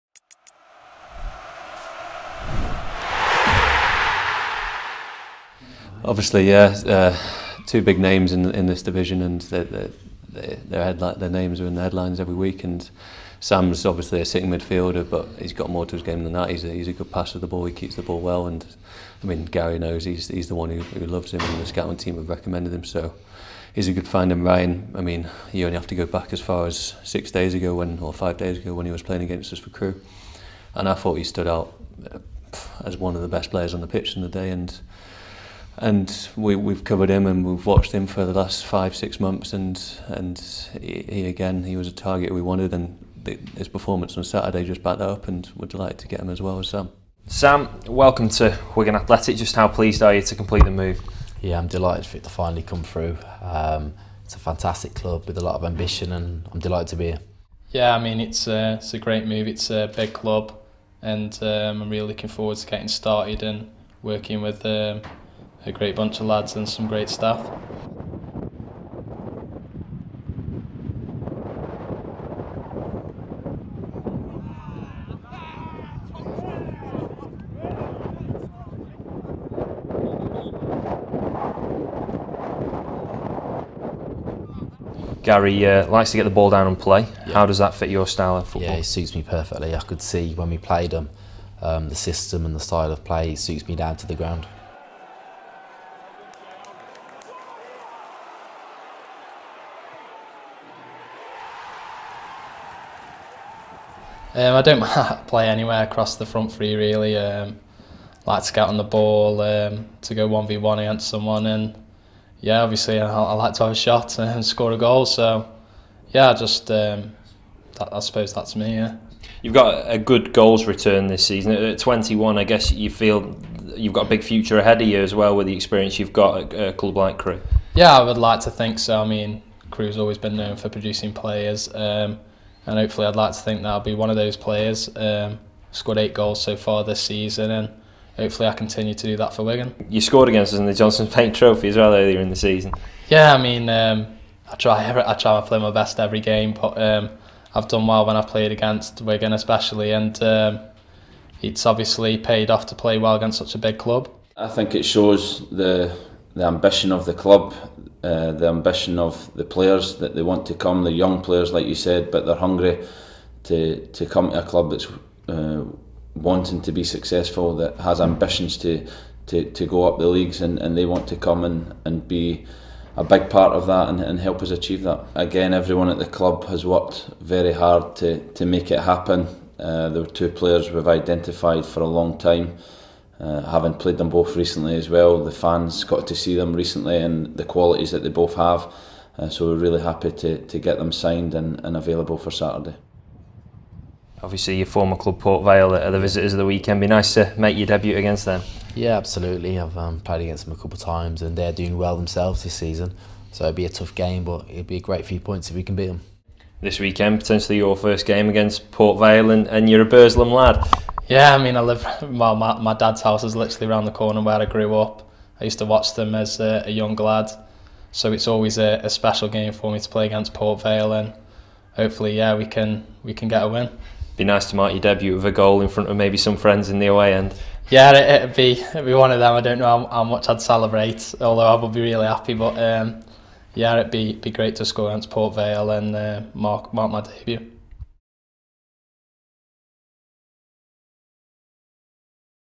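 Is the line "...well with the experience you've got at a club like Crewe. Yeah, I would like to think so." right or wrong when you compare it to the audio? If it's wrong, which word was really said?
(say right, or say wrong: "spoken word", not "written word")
right.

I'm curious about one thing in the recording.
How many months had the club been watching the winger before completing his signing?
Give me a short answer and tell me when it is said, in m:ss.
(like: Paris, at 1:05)
5 or 6 months, at 0:38.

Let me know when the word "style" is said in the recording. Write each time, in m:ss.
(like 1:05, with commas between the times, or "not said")
1:28, 1:32.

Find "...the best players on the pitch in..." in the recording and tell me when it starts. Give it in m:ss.
0:33.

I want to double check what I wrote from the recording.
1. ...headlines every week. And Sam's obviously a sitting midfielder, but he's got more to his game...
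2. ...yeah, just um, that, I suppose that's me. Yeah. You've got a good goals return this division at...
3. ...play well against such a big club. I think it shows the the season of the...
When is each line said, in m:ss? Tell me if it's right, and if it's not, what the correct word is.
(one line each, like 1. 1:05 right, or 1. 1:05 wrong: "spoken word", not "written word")
1. 0:11 right
2. 1:56 wrong: "season", not "division"
3. 2:32 wrong: "ambition", not "season".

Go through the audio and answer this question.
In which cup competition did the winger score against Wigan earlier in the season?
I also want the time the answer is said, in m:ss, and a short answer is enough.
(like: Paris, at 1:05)
Johnstone's Paint Trophy, at 2:20.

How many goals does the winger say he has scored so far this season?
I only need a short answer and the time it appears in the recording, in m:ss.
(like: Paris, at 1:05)
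8, at 2:15.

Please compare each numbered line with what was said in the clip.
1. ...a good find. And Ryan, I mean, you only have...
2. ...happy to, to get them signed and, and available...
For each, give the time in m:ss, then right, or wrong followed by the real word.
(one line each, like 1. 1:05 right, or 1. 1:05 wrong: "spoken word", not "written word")
1. 0:23 right
2. 3:09 right.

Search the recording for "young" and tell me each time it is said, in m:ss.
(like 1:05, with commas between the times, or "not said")
2:40, 3:36.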